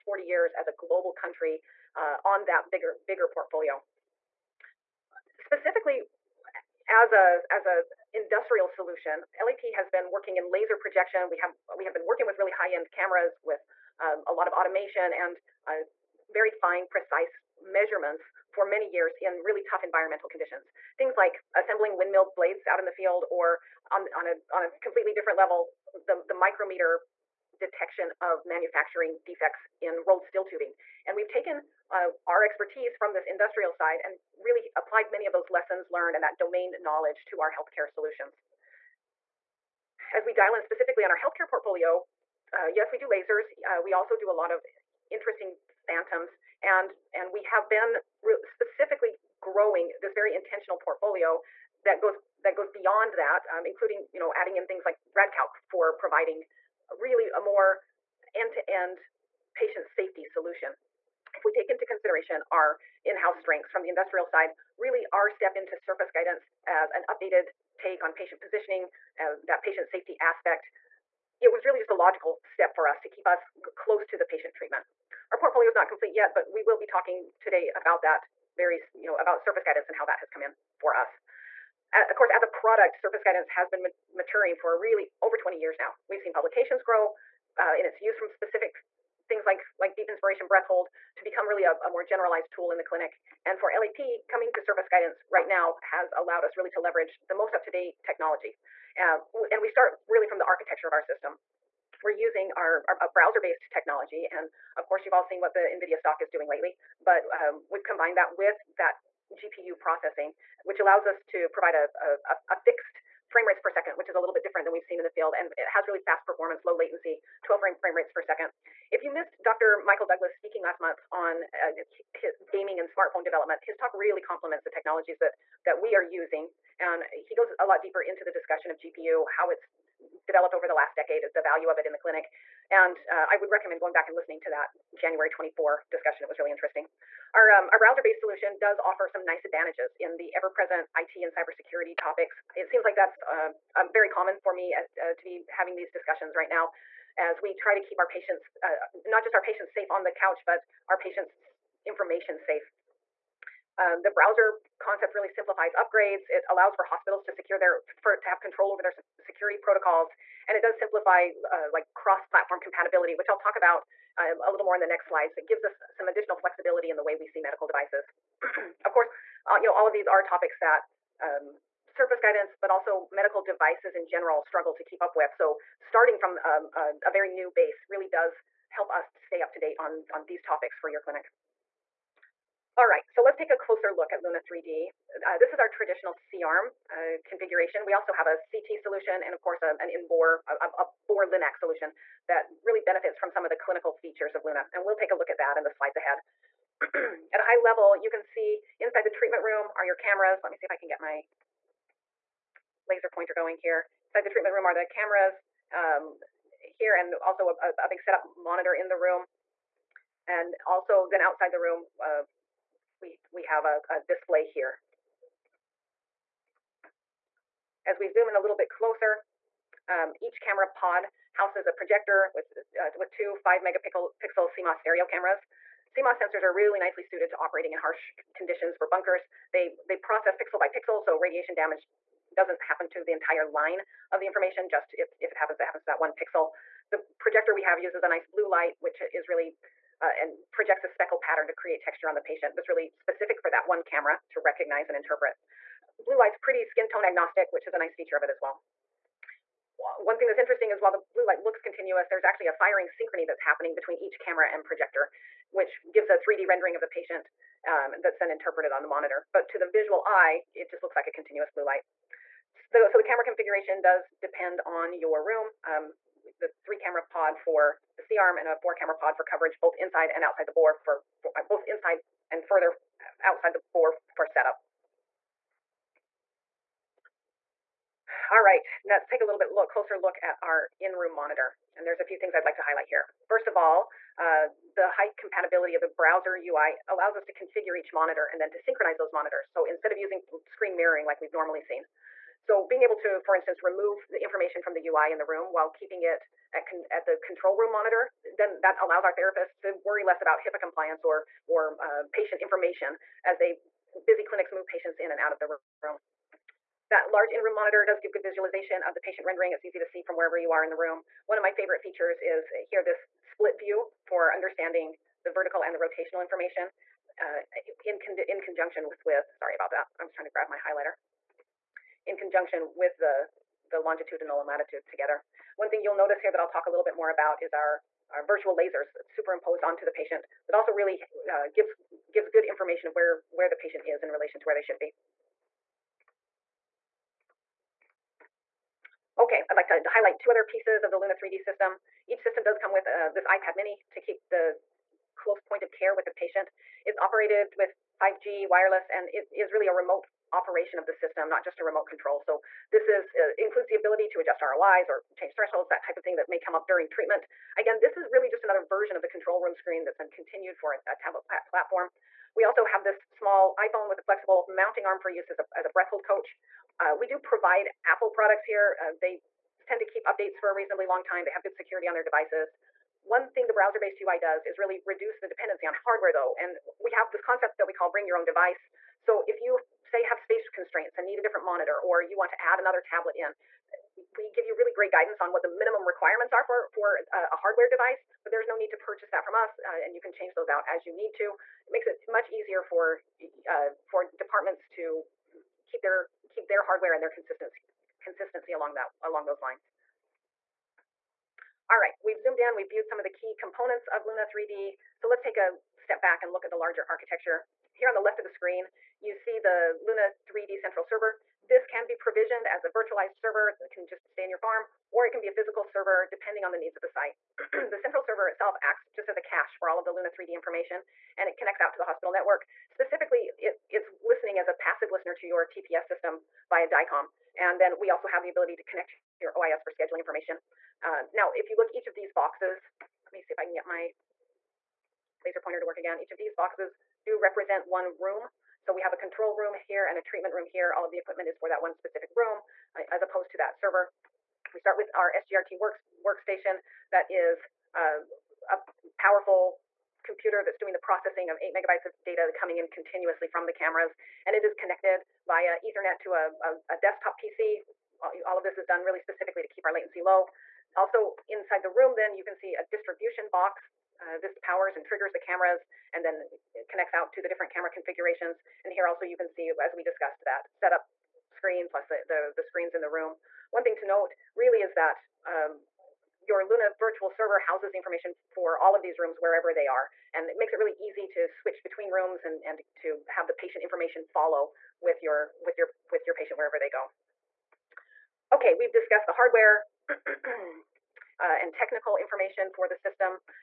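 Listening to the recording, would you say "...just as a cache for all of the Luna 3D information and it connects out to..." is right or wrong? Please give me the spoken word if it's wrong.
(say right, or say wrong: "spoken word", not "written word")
right.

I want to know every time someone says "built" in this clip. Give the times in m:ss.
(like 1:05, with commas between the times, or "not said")
not said.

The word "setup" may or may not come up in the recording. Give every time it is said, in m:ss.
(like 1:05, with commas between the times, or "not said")
3:27, 4:34, 7:50.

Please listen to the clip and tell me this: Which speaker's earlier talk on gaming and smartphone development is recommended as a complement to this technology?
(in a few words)
Dr. Michael Douglas.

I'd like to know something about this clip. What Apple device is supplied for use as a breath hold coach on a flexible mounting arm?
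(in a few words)
iPhone.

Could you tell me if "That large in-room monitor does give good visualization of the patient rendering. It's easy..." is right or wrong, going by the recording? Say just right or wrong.
right.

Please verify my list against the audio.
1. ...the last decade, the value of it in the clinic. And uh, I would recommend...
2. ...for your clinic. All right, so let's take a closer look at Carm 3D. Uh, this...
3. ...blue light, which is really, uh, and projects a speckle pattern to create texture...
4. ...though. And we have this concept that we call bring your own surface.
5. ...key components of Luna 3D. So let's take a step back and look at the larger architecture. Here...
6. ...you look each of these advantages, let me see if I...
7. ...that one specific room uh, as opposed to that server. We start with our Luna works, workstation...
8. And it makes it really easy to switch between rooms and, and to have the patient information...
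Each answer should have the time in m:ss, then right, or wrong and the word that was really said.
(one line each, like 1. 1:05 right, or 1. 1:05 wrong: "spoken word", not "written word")
1. 2:10 right
2. 3:00 wrong: "Luna", not "Carm"
3. 3:58 right
4. 6:16 wrong: "device", not "surface"
5. 6:43 right
6. 7:11 wrong: "boxes", not "advantages"
7. 7:21 wrong: "SGRT", not "Luna"
8. 8:00 right.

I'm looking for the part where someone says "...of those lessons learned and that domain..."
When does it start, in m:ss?
0:35.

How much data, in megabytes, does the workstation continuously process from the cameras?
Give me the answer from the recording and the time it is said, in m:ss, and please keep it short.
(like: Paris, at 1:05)
8 megabytes, at 7:31.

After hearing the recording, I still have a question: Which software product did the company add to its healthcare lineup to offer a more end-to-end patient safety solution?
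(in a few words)
RadCalc.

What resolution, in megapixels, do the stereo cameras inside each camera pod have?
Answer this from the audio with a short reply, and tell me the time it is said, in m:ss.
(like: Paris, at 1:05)
5 megapixels, at 3:43.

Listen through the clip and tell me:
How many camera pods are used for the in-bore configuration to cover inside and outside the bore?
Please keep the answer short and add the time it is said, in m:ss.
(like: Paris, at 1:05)
4, at 4:28.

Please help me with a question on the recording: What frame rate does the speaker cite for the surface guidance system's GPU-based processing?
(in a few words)
12 frames per second.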